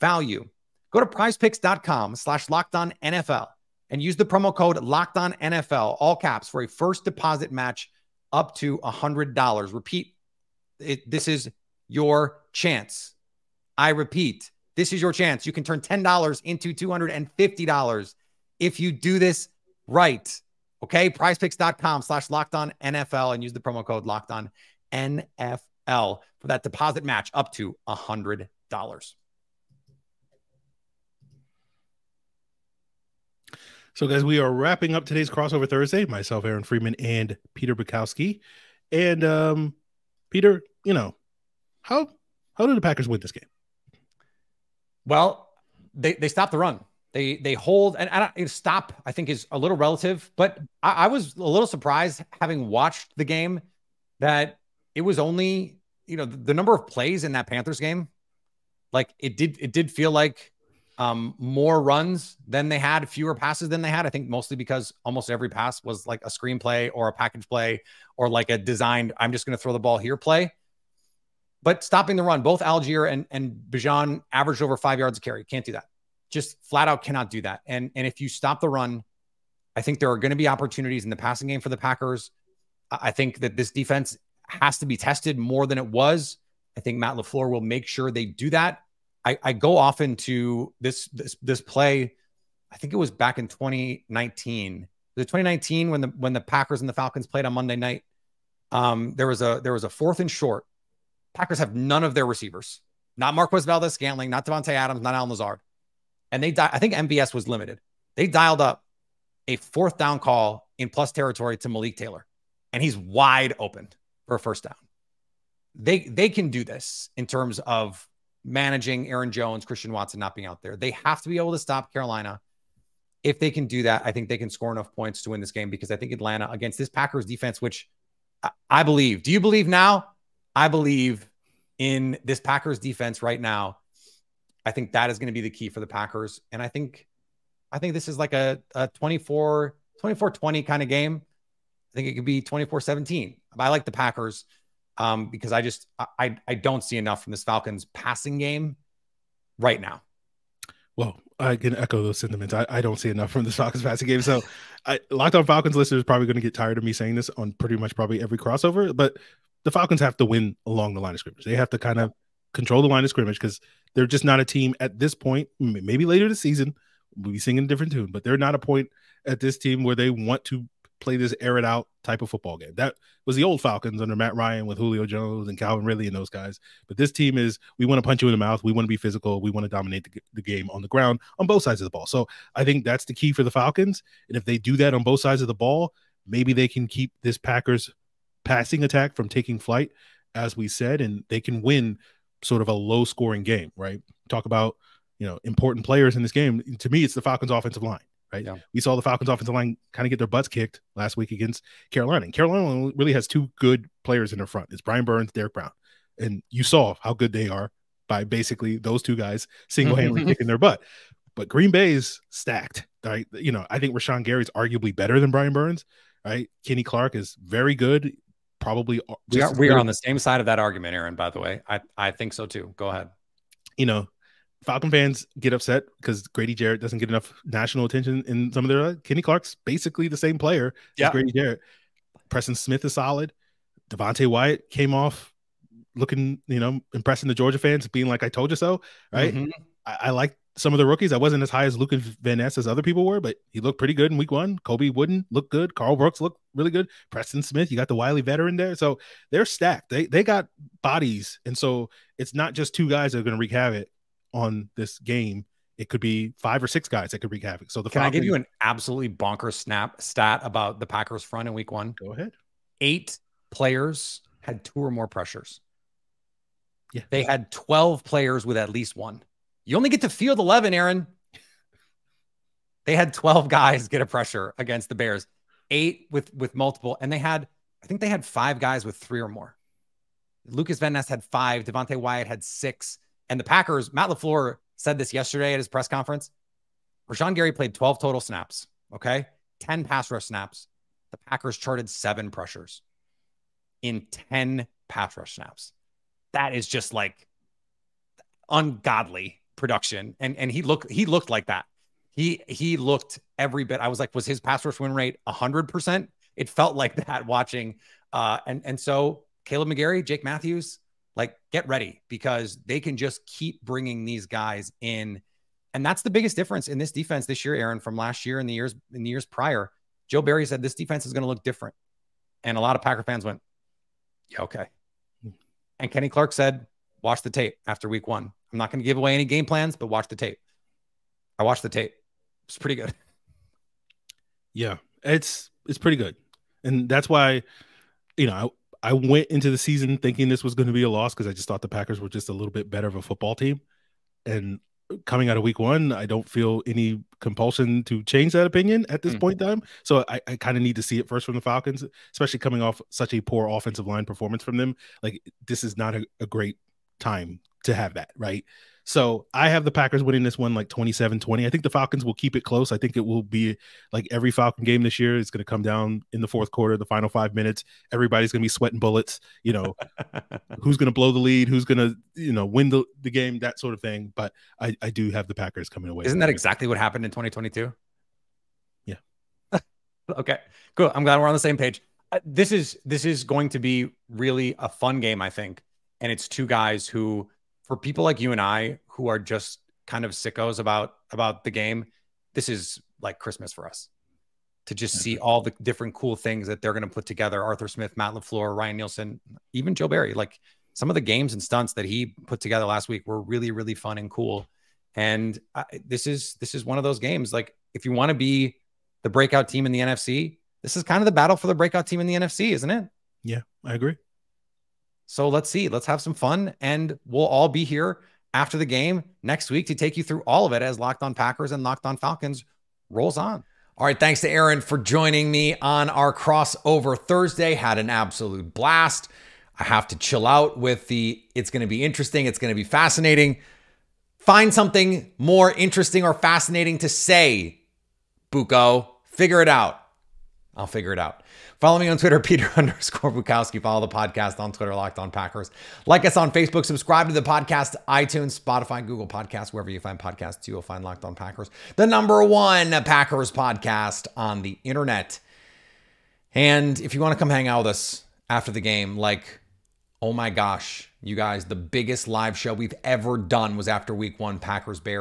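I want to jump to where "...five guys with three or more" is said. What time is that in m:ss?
4:38.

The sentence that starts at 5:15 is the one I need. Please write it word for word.
And that's the biggest difference in this defense this year, Aaron, from last year and the years in the years prior.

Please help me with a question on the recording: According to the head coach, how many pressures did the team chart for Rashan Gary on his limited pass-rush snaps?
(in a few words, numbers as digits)
7.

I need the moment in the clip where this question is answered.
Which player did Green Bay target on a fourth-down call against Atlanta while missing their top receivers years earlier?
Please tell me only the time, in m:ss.
1:51.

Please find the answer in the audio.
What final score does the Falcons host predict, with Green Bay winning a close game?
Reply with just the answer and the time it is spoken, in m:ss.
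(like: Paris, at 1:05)
27-20, at 6:00.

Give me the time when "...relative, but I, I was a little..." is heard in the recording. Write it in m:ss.
0:49.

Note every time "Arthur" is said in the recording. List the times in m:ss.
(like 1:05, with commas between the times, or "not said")
6:37.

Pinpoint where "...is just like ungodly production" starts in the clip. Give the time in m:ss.
4:56.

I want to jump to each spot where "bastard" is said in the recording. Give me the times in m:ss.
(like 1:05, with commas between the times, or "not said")
not said.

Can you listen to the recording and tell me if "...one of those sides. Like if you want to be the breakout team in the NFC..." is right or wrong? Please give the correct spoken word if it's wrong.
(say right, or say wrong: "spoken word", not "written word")
wrong: "games", not "sides".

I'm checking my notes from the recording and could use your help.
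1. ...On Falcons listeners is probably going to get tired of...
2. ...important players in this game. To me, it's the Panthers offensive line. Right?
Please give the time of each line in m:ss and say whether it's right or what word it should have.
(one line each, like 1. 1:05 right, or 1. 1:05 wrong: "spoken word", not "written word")
1. 2:35 right
2. 3:15 wrong: "Falcons", not "Panthers".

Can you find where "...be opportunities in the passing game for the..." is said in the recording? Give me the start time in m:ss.
1:20.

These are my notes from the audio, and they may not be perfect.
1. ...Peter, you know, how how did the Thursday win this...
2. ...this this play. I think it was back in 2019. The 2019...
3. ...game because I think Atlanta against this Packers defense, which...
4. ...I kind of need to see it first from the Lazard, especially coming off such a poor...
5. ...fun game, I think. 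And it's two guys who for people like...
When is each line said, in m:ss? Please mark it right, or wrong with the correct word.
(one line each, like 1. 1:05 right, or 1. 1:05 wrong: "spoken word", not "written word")
1. 0:40 wrong: "Packers", not "Thursday"
2. 1:31 right
3. 2:05 right
4. 5:50 wrong: "Falcons", not "Lazard"
5. 6:24 right.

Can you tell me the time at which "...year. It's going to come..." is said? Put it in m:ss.
6:04.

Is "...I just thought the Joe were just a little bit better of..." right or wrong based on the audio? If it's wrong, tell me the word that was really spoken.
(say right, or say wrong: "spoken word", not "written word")
wrong: "Packers", not "Joe".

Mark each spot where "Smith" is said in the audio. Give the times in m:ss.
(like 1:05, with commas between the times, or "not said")
3:52, 4:07, 6:37.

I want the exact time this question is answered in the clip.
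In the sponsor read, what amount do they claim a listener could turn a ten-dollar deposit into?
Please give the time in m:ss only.
0:16.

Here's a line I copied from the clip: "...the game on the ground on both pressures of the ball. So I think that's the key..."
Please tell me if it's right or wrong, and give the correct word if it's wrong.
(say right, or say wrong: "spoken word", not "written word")
wrong: "sides", not "pressures".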